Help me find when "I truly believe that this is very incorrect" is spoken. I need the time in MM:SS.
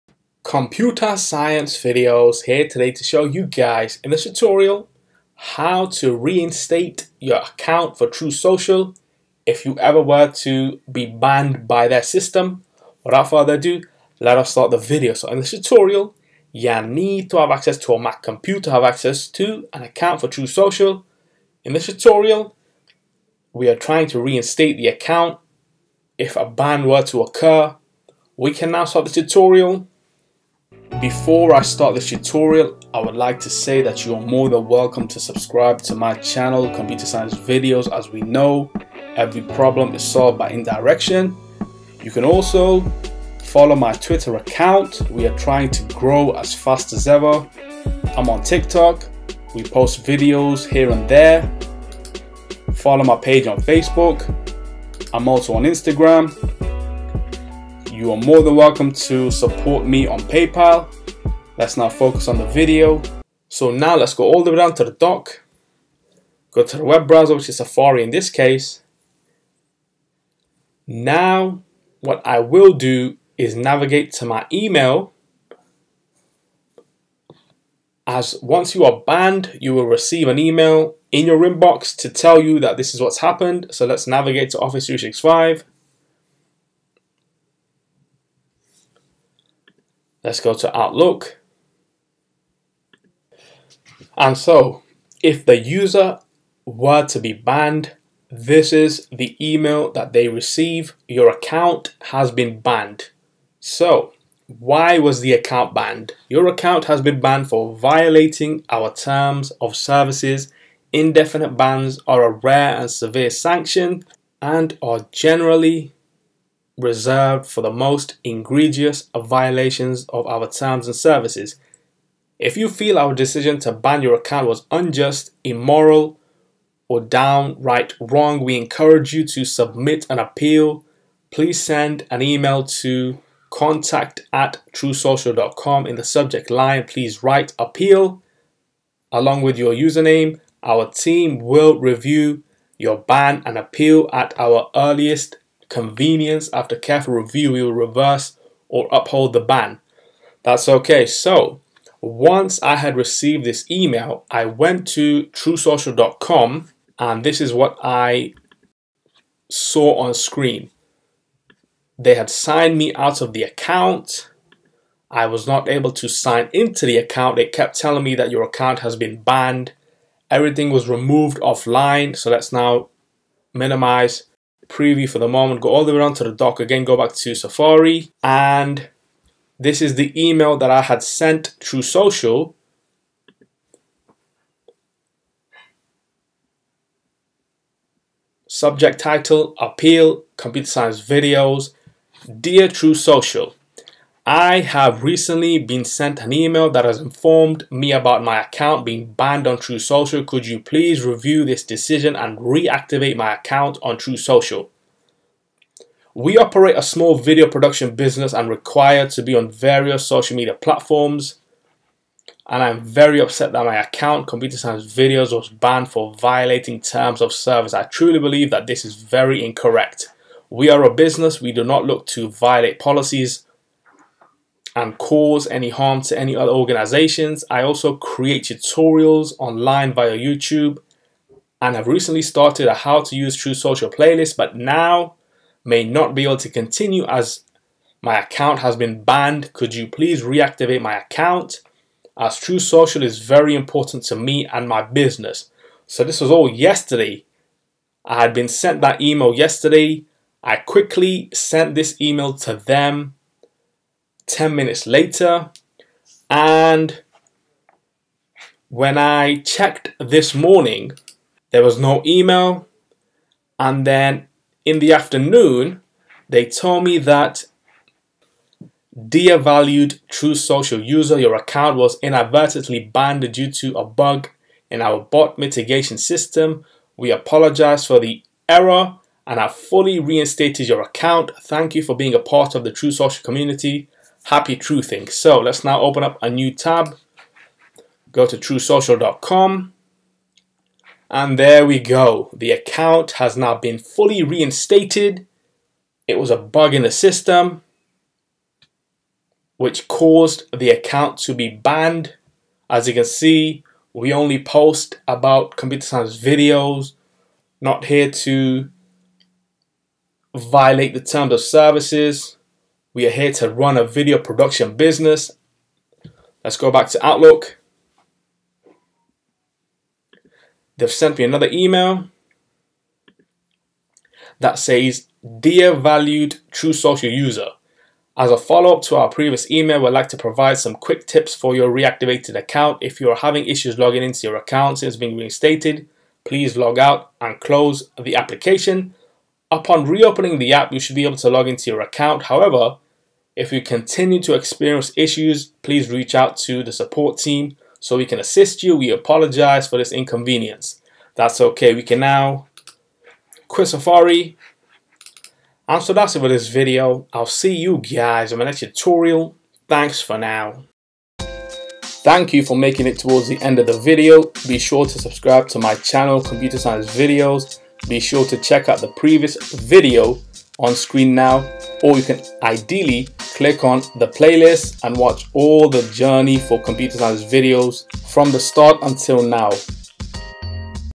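03:37.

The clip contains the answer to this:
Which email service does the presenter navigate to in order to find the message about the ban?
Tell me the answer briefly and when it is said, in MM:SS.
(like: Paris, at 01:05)
Office 365, at 01:24.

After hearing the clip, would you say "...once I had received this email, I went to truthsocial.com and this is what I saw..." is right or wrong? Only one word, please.
right.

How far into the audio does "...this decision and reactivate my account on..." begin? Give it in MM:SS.
03:21.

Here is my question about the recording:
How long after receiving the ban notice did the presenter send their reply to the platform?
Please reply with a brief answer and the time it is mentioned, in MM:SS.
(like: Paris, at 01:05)
10 minutes, at 04:14.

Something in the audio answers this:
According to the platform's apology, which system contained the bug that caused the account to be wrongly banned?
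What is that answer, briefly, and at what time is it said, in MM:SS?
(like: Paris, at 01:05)
bot mitigation system, at 04:34.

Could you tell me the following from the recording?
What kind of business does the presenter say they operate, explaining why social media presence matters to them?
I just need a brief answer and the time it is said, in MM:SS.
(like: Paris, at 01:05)
small video production business, at 03:26.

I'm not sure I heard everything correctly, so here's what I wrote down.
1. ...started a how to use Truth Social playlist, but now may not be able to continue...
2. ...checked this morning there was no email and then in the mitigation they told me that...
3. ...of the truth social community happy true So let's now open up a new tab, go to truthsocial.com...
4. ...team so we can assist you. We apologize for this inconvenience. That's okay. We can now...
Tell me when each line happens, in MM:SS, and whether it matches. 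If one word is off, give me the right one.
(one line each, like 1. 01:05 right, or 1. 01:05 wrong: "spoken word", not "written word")
1. 03:52 right
2. 04:19 wrong: "afternoon", not "mitigation"
3. 04:42 right
4. 05:47 right.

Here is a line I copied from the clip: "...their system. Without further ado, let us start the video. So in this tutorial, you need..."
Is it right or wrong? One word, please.
right.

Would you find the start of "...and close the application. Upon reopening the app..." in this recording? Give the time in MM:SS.
05:37.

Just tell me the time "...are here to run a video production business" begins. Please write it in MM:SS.
05:13.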